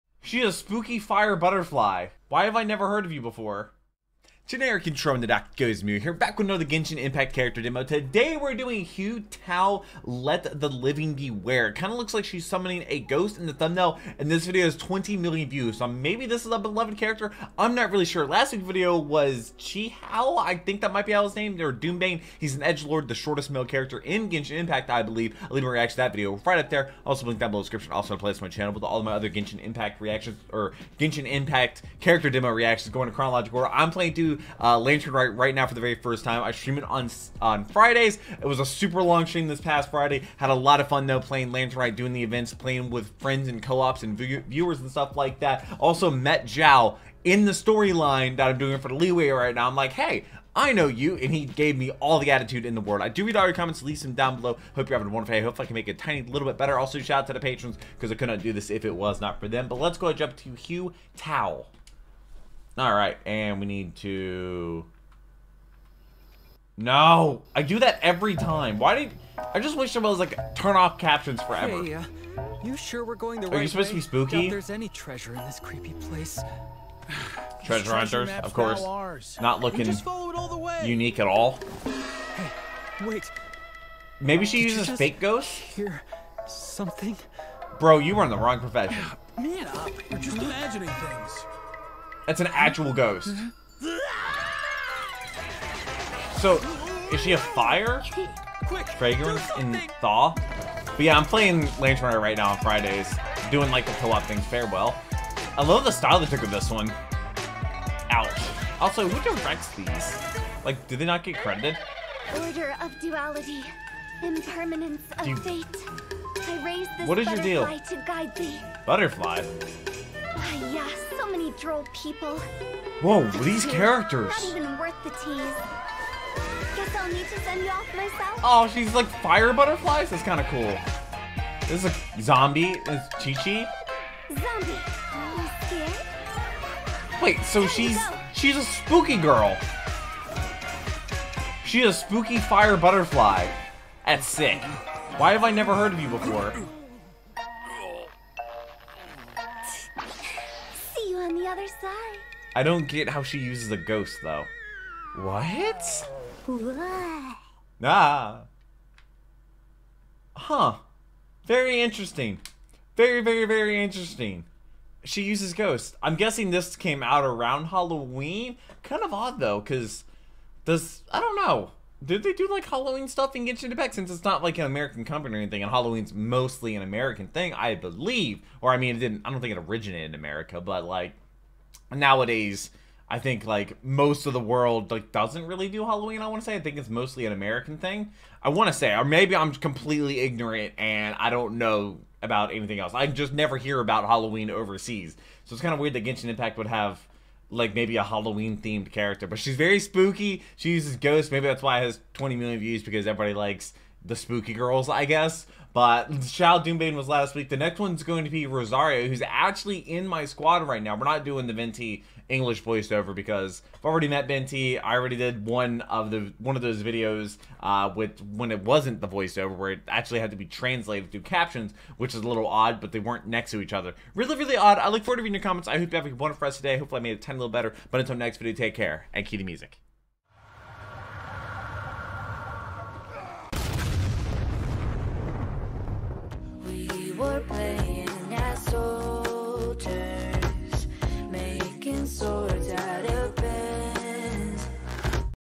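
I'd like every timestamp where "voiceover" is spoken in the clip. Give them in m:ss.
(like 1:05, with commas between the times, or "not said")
3:32, 3:39.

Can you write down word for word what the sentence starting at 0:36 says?
I stream it on on Fridays.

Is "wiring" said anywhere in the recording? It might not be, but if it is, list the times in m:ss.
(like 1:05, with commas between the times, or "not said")
not said.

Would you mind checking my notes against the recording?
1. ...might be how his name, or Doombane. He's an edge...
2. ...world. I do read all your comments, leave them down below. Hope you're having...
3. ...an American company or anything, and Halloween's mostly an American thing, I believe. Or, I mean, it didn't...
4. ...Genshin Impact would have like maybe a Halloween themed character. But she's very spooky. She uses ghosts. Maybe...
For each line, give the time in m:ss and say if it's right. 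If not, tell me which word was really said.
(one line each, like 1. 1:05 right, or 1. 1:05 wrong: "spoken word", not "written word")
1. 0:20 right
2. 0:52 right
3. 2:54 right
4. 3:16 right.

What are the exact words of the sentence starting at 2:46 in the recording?
I'm guessing this came out around Halloween.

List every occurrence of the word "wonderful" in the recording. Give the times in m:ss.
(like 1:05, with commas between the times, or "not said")
0:55, 3:46.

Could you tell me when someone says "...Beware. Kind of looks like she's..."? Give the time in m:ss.
0:11.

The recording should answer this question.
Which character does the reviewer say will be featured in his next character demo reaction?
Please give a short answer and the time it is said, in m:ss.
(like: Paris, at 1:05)
Rosaria, at 3:28.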